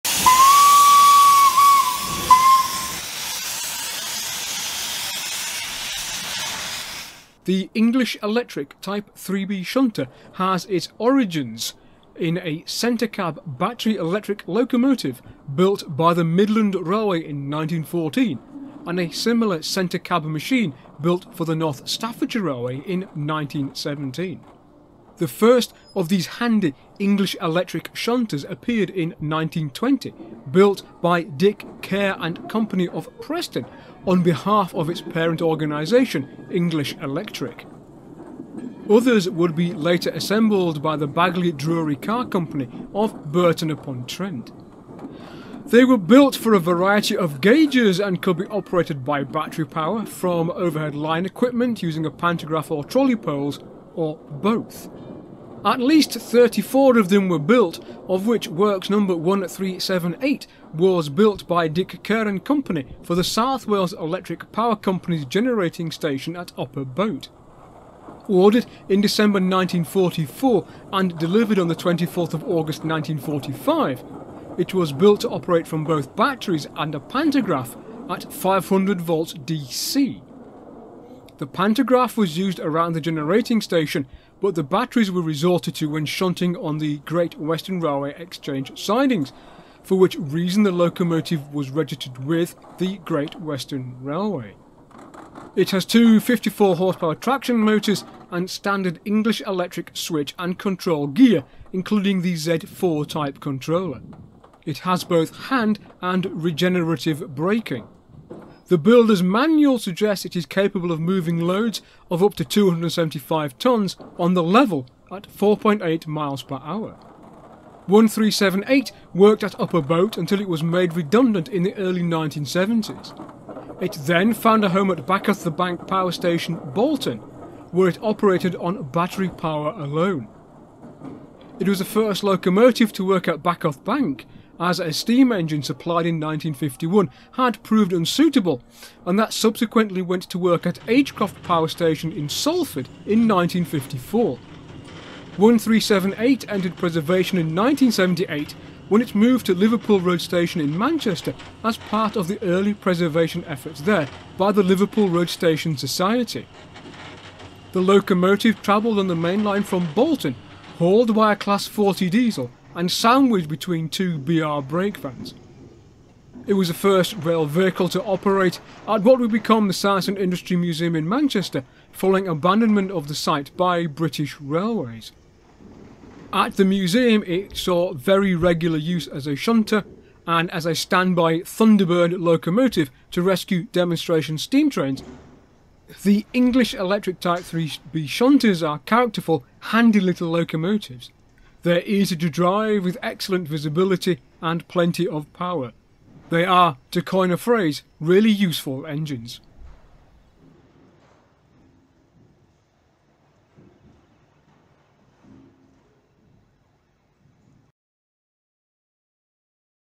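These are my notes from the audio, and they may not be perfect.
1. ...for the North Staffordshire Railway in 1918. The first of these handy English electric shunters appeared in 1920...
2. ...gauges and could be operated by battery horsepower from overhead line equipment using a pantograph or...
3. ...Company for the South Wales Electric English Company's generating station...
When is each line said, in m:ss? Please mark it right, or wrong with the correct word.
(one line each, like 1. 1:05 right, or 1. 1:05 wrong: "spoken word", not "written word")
1. 0:21 wrong: "1917", not "1918"
2. 0:47 wrong: "power", not "horsepower"
3. 1:02 wrong: "Power", not "English".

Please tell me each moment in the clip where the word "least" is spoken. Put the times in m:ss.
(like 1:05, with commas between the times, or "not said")
0:55.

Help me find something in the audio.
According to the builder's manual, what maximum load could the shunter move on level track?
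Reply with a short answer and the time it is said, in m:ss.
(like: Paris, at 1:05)
275 tons, at 1:52.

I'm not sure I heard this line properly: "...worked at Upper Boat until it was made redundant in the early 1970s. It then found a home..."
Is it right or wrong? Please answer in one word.
right.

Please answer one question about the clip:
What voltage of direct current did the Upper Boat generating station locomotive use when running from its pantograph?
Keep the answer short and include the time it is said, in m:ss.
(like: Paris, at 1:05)
500 volts, at 1:18.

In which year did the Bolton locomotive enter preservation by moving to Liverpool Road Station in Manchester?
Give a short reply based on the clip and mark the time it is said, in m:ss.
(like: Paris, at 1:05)
1978, at 2:27.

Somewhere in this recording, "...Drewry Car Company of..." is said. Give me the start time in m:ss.
0:41.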